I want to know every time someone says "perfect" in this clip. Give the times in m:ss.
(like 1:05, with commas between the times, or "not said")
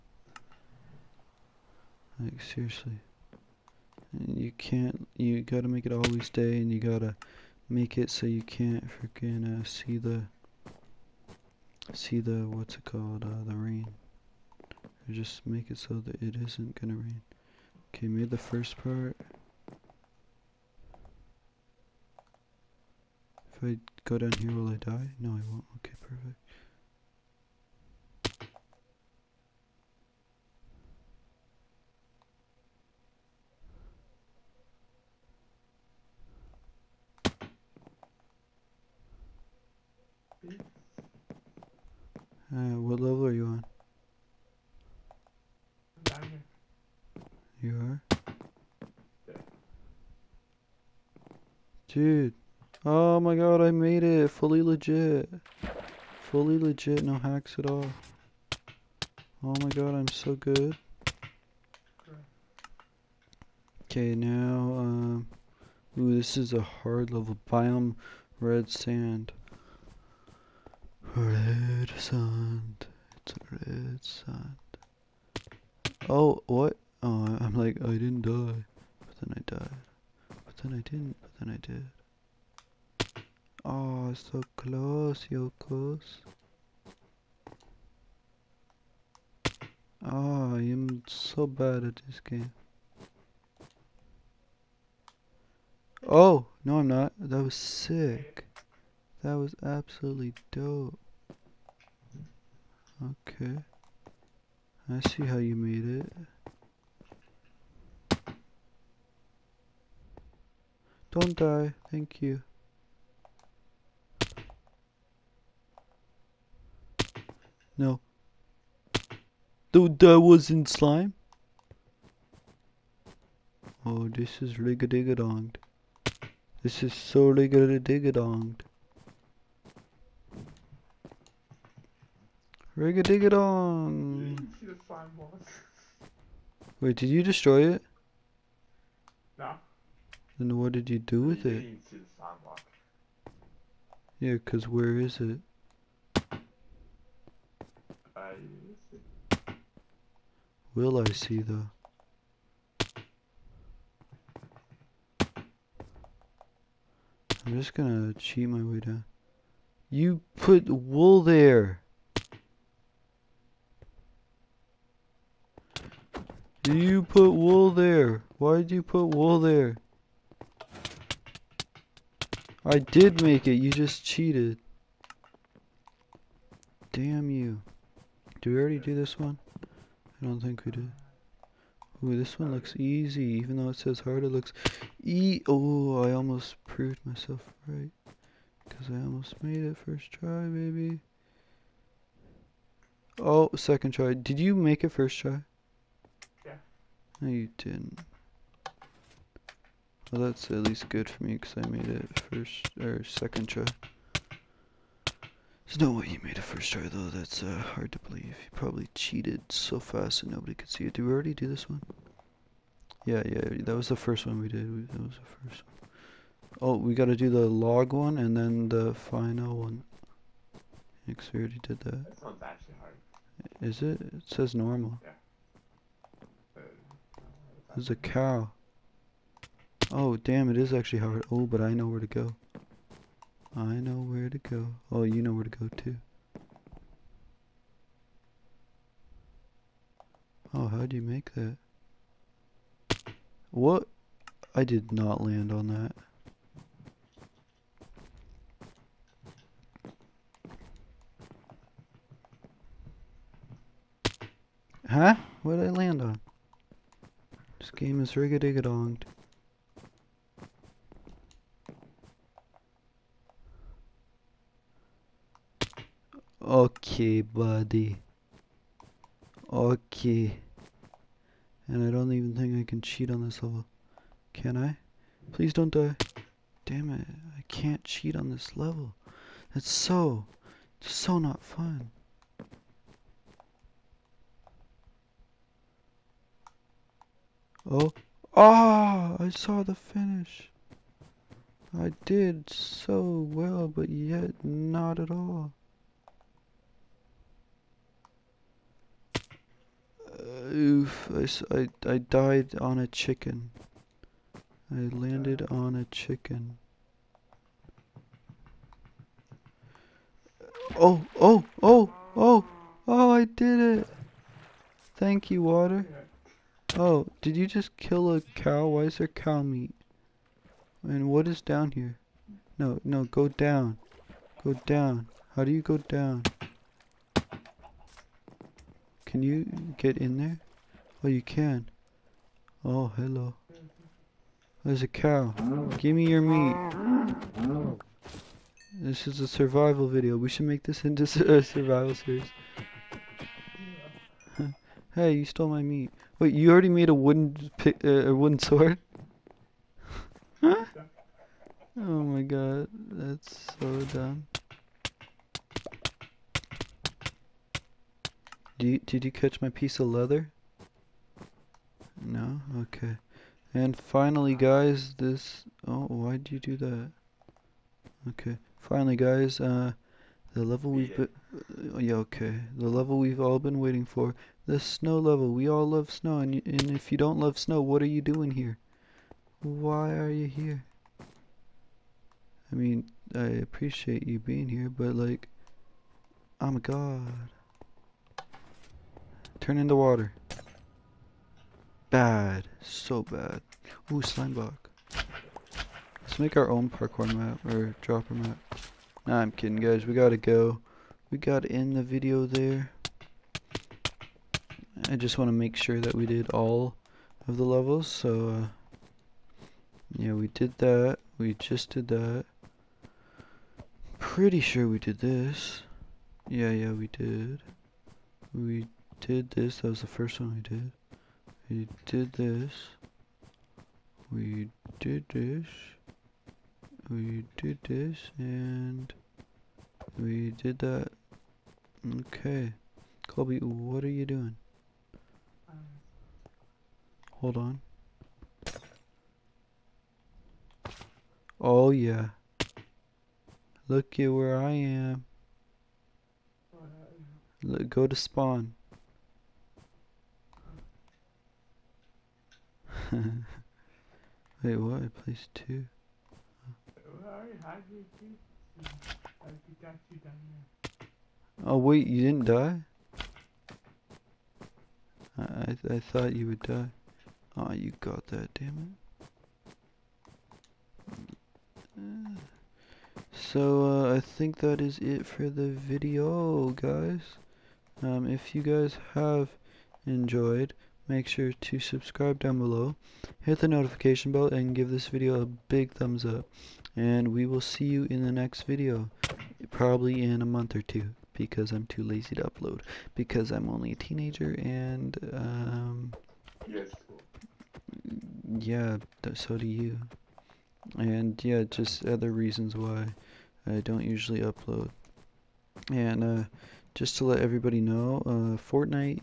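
0:26.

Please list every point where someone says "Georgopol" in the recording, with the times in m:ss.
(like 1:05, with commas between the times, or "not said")
not said.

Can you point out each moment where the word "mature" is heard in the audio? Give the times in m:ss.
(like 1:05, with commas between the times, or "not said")
not said.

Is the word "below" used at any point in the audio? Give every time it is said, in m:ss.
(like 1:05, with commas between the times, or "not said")
8:02.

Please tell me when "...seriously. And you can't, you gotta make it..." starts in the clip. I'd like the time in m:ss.
0:02.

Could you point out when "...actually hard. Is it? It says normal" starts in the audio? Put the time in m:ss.
3:42.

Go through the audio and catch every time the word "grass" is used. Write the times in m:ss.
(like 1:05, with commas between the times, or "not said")
not said.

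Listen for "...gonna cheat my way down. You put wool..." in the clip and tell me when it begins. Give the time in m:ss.
2:37.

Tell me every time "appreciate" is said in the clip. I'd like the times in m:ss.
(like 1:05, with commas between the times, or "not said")
6:23.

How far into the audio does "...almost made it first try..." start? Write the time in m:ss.
3:08.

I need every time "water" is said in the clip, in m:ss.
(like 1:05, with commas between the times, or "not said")
5:15, 6:29.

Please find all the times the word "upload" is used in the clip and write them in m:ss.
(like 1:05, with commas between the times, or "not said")
8:12, 8:24.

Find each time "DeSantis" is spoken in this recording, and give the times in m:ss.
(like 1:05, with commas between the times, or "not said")
not said.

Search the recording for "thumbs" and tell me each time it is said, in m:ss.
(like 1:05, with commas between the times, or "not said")
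8:05.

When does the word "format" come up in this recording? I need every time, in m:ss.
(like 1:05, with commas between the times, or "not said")
not said.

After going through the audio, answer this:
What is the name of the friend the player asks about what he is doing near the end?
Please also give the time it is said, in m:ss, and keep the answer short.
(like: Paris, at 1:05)
Colby, at 7:13.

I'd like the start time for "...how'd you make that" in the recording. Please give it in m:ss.
4:00.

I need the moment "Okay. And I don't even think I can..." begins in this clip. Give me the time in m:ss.
4:29.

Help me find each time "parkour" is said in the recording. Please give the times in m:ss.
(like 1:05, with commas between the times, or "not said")
6:36.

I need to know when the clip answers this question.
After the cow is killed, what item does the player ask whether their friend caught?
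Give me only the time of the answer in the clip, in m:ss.
5:59.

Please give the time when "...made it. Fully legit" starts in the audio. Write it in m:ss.
0:53.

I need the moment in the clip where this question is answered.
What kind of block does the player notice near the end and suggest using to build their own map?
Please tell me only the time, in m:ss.
6:34.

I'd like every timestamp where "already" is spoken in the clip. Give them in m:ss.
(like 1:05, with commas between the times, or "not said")
2:58, 3:31, 3:41, 5:46.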